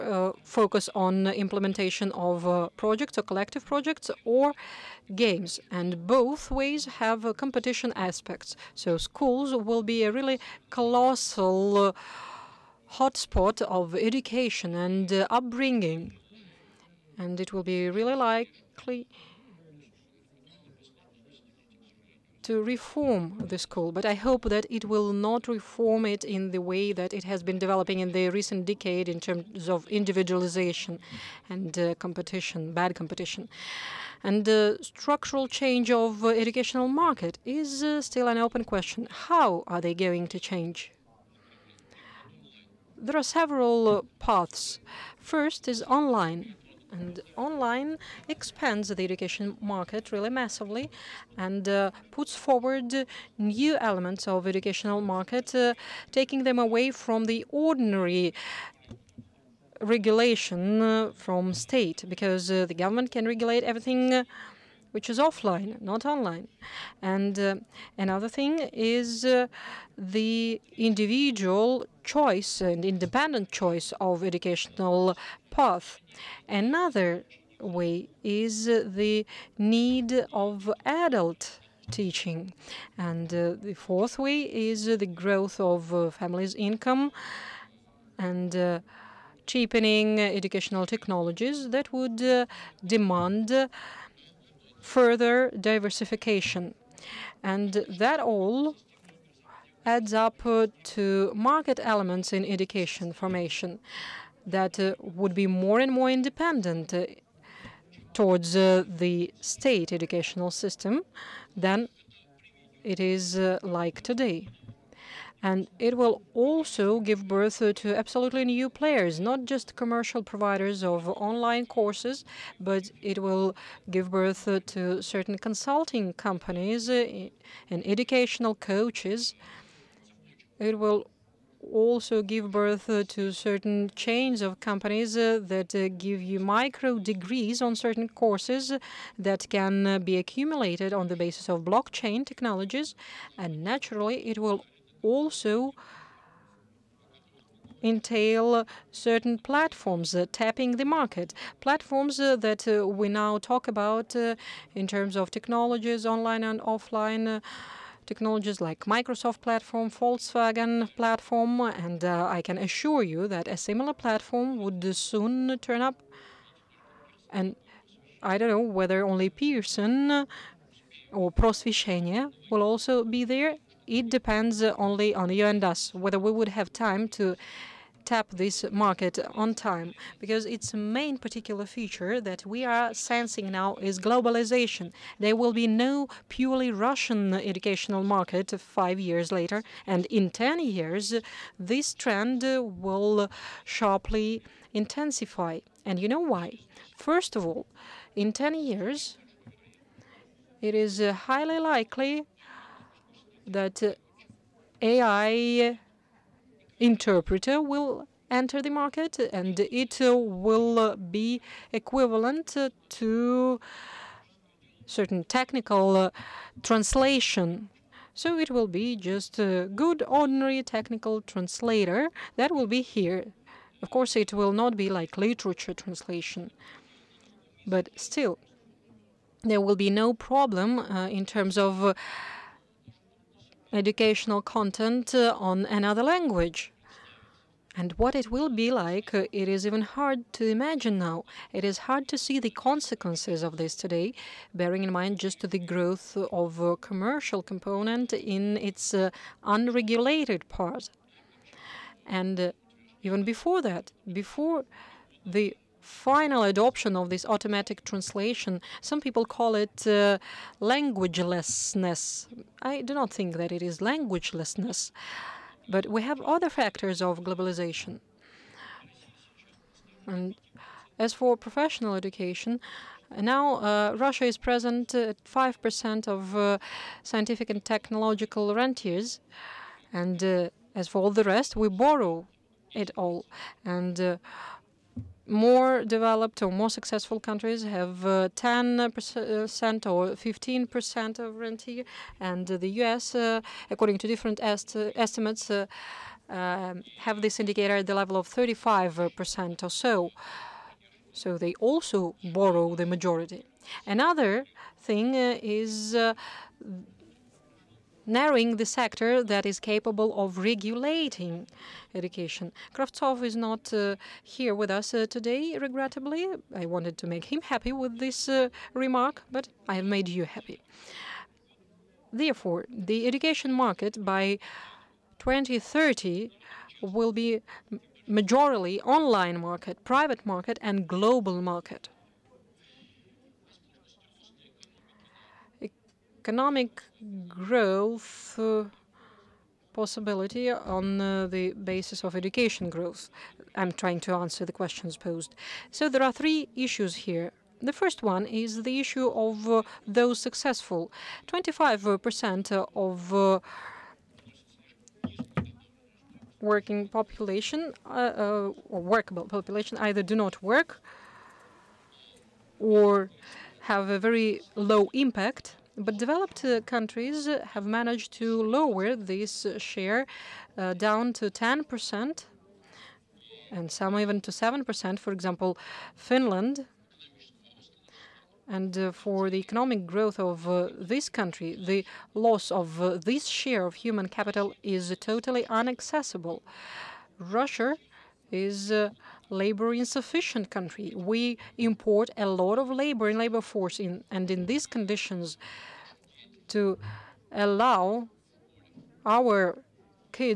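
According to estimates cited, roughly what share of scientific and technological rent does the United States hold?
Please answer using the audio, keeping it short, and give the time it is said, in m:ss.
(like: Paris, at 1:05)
35%, at 4:58.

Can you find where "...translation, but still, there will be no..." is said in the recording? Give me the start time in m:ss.
3:45.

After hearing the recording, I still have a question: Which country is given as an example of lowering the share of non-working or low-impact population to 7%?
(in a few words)
Finland.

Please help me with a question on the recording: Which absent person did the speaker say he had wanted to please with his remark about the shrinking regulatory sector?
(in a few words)
Kravtsov.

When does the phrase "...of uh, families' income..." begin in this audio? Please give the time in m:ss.
1:25.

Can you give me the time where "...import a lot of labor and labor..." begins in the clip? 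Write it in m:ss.
6:31.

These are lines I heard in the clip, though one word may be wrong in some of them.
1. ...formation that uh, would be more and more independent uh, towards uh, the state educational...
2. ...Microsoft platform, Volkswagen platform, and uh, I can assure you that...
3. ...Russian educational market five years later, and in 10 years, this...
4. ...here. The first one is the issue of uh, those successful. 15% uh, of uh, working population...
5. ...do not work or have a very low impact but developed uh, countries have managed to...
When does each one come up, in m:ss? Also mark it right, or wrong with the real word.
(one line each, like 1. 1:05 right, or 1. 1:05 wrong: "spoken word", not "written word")
1. 1:43 right
2. 2:38 right
3. 3:06 right
4. 5:47 wrong: "25", not "15"
5. 6:00 right.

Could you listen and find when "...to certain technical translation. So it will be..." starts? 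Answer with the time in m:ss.
3:32.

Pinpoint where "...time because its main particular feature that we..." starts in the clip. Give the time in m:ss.
2:59.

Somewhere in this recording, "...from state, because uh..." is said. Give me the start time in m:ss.
1:01.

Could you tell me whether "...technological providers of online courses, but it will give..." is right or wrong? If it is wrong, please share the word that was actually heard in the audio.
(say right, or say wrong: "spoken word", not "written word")
wrong: "commercial", not "technological".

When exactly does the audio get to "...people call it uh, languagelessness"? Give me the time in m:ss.
4:18.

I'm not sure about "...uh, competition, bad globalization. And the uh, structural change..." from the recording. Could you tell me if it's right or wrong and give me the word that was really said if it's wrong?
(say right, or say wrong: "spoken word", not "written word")
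wrong: "competition", not "globalization".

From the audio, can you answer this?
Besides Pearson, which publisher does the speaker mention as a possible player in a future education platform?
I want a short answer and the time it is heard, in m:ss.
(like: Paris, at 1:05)
Prosveshcheniye, at 2:51.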